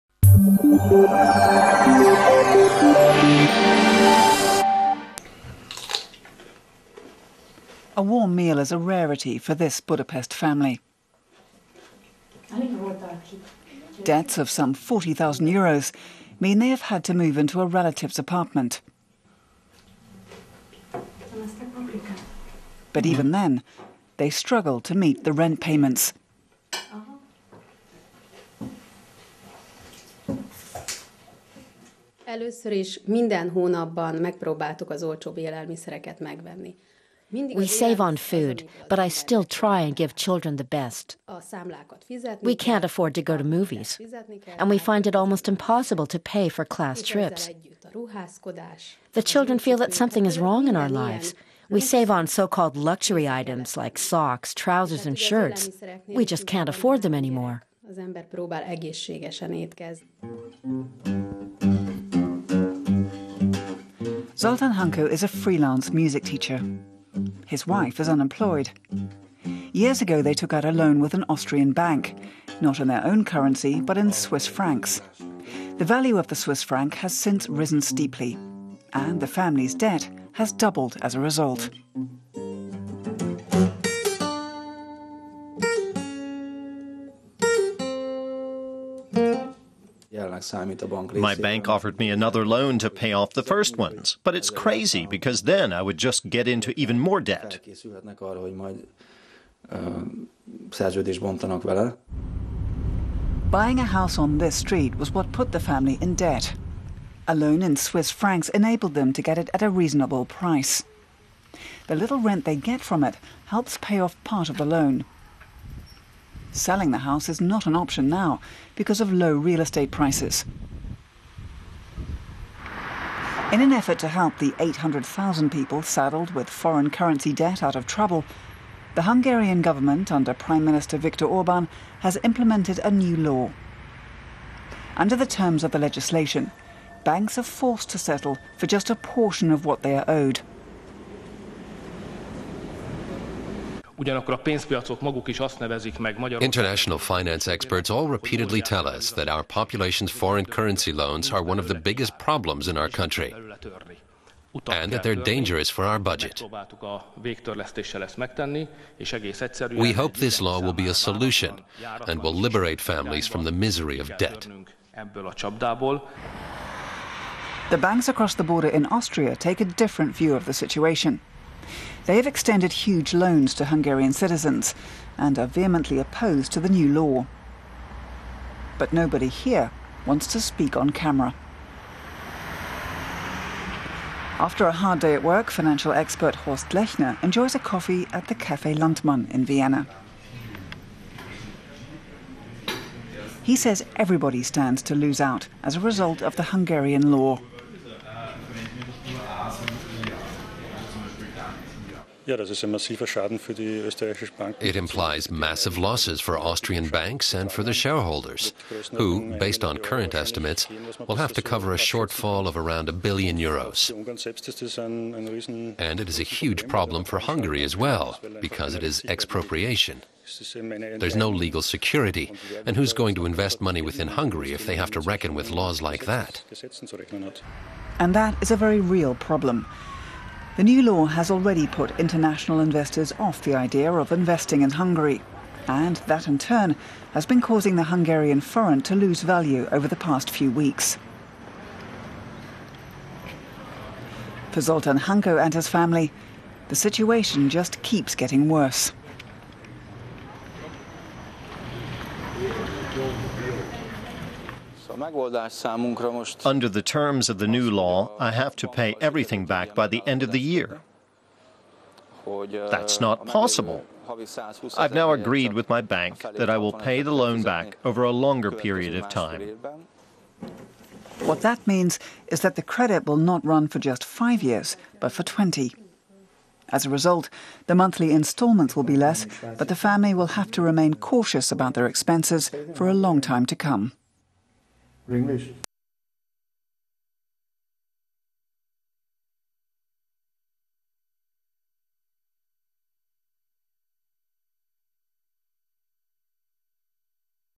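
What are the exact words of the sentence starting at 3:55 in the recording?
And that in turn has been causing the Hungarian forint to lose value over the past few weeks.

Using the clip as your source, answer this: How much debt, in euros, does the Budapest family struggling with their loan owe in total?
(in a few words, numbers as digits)
40,000 euros.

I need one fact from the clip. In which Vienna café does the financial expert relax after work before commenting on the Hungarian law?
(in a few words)
Café Landtmann.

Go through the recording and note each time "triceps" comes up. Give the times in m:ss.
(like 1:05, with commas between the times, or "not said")
not said.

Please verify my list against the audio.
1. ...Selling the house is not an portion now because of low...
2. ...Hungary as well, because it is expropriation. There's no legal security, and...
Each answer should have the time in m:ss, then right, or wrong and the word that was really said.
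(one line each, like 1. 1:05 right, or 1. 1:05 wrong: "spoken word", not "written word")
1. 1:56 wrong: "option", not "portion"
2. 3:37 right.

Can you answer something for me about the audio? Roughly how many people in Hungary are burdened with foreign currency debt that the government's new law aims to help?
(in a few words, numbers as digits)
800,000.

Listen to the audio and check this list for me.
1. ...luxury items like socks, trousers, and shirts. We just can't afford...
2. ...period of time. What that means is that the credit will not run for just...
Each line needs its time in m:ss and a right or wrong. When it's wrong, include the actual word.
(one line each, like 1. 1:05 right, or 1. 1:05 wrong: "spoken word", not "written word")
1. 0:52 right
2. 4:28 right.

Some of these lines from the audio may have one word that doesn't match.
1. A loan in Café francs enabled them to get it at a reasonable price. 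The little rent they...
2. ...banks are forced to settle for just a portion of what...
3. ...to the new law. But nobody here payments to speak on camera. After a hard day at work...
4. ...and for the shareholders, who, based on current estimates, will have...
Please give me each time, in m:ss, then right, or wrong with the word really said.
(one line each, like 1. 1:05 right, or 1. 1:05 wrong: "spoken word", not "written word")
1. 1:47 wrong: "Swiss", not "Café"
2. 2:17 right
3. 2:56 wrong: "wants", not "payments"
4. 3:27 right.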